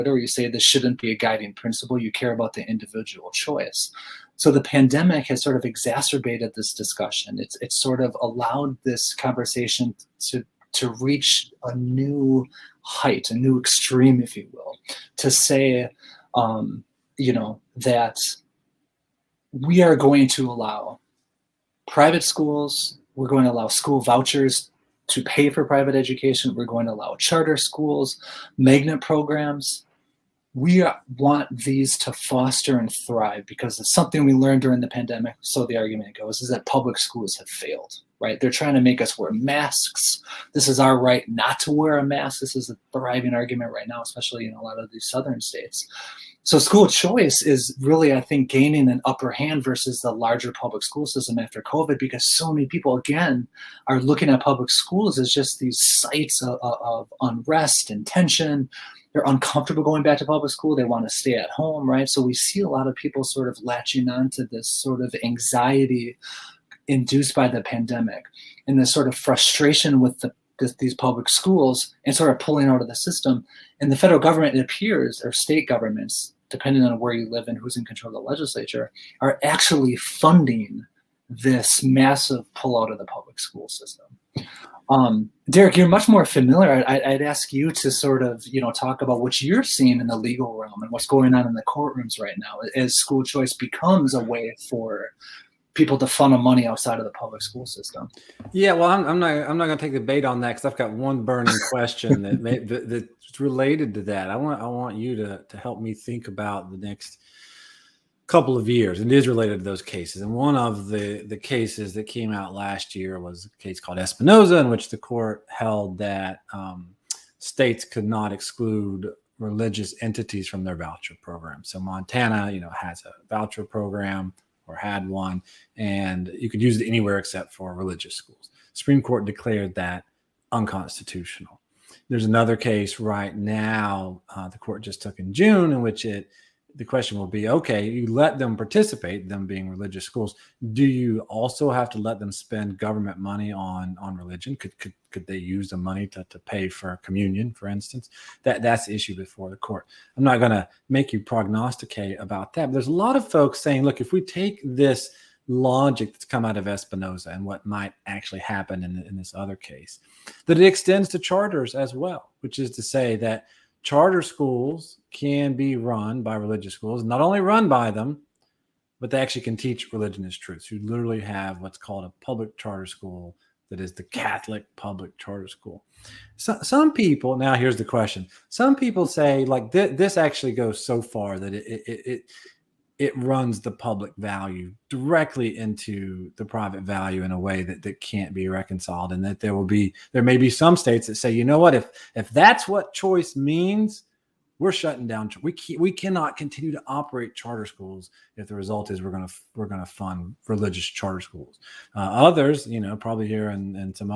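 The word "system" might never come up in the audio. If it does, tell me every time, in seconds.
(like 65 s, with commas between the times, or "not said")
51 s, 72 s, 83 s, 97 s.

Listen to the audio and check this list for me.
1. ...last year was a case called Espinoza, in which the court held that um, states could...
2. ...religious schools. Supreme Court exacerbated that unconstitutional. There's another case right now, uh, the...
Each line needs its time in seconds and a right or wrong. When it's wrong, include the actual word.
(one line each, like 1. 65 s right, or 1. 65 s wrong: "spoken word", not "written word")
1. 112 s right
2. 127 s wrong: "declared", not "exacerbated".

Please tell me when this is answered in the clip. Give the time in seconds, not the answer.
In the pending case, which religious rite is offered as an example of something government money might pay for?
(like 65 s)
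147 s.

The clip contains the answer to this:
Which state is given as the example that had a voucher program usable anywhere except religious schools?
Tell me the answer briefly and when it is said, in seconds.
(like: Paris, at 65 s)
Montana, at 121 s.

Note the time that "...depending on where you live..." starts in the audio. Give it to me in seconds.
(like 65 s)
76 s.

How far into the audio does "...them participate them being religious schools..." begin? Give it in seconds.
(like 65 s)
138 s.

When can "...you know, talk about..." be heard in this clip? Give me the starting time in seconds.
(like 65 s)
88 s.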